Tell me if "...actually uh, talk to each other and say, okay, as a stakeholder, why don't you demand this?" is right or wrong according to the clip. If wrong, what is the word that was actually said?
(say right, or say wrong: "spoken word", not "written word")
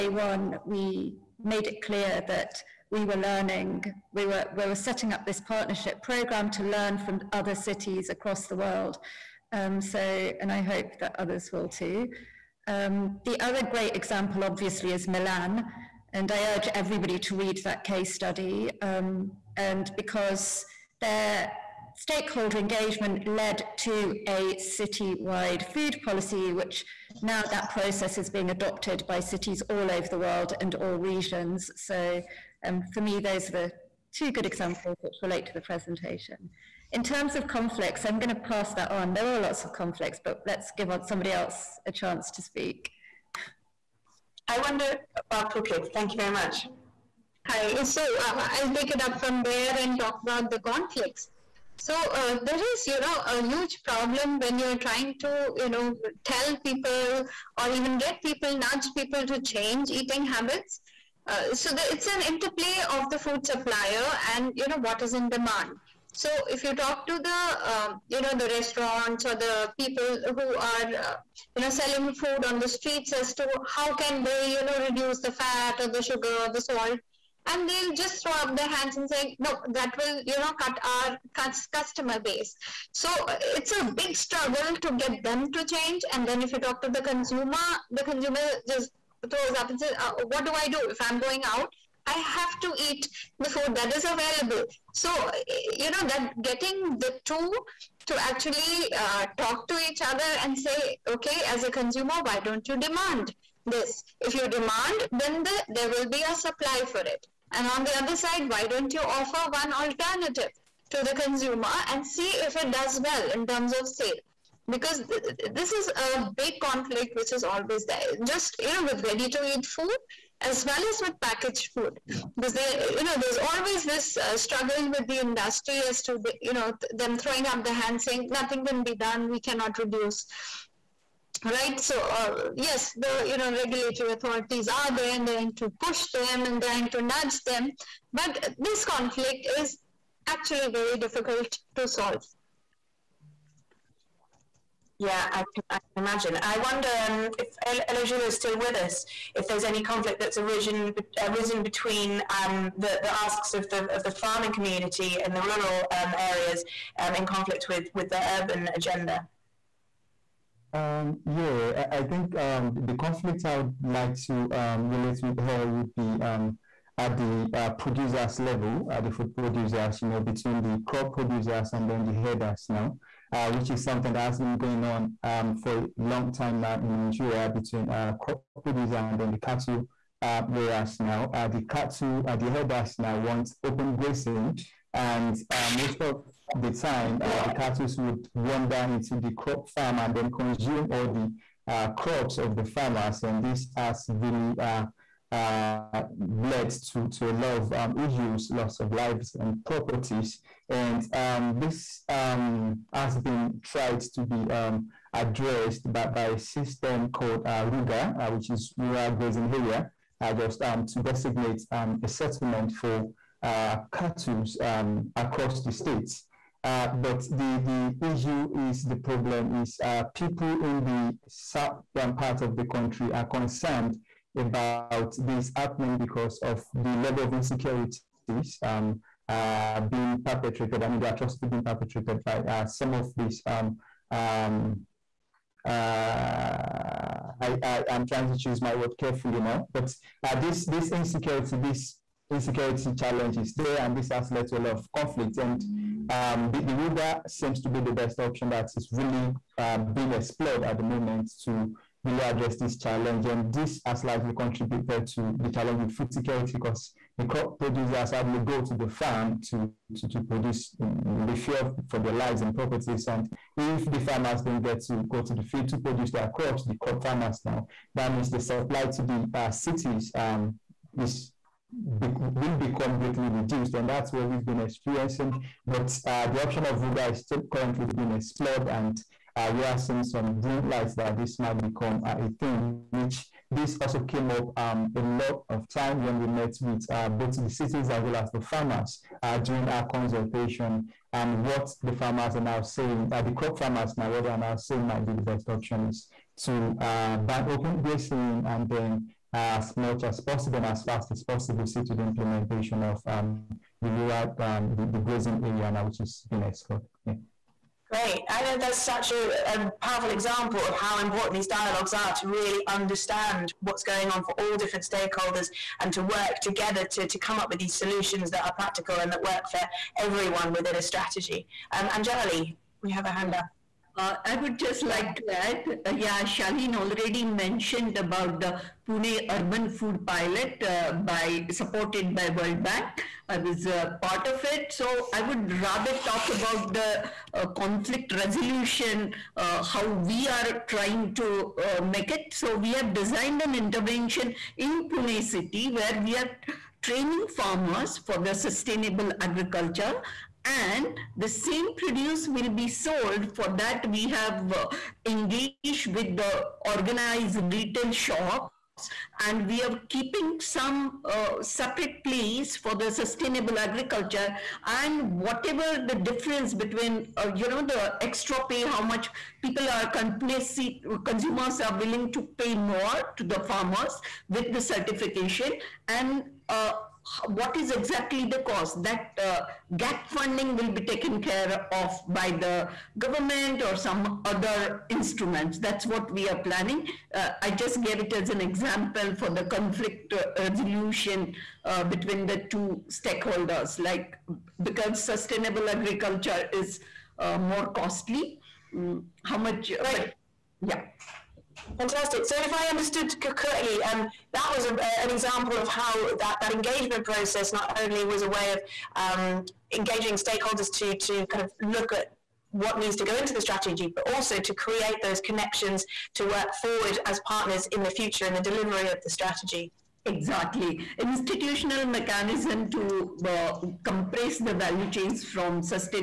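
wrong: "consumer", not "stakeholder".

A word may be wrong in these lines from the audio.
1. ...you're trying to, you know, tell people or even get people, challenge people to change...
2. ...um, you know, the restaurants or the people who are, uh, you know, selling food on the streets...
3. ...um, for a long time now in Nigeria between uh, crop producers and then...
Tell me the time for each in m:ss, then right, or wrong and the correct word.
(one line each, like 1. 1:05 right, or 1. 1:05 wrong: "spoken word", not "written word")
1. 0:54 wrong: "nudge", not "challenge"
2. 1:07 right
3. 2:55 right.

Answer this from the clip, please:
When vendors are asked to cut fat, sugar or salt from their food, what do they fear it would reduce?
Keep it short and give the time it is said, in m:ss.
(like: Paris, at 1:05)
Customer base, at 1:21.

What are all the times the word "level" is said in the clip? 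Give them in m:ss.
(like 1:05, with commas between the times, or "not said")
2:48, 3:46.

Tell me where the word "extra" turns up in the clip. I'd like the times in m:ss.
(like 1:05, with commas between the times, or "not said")
6:07.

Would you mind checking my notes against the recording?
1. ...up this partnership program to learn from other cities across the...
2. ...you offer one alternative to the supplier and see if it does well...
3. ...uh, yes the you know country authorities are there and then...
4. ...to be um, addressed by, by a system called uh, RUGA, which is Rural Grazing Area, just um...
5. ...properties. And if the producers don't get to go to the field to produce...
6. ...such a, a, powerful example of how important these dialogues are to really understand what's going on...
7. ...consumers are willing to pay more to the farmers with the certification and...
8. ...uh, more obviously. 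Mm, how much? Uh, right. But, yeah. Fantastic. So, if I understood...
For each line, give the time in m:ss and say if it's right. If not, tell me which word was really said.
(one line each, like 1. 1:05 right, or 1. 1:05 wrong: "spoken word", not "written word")
1. 0:05 right
2. 1:48 wrong: "consumer", not "supplier"
3. 2:12 wrong: "regulatory", not "country"
4. 3:24 right
5. 4:22 wrong: "farmers", not "producers"
6. 5:08 right
7. 6:11 right
8. 6:37 wrong: "costly", not "obviously".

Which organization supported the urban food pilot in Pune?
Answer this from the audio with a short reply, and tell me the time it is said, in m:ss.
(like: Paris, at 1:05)
World Bank, at 5:32.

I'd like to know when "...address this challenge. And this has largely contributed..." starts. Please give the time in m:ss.
4:12.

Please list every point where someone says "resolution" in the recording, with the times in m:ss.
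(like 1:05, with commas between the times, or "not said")
5:38, 6:30.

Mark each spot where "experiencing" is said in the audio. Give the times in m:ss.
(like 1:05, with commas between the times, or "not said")
4:34.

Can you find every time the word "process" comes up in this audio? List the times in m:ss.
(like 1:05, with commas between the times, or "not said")
0:27, 6:47.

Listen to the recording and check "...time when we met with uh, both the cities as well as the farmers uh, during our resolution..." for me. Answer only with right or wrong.
wrong.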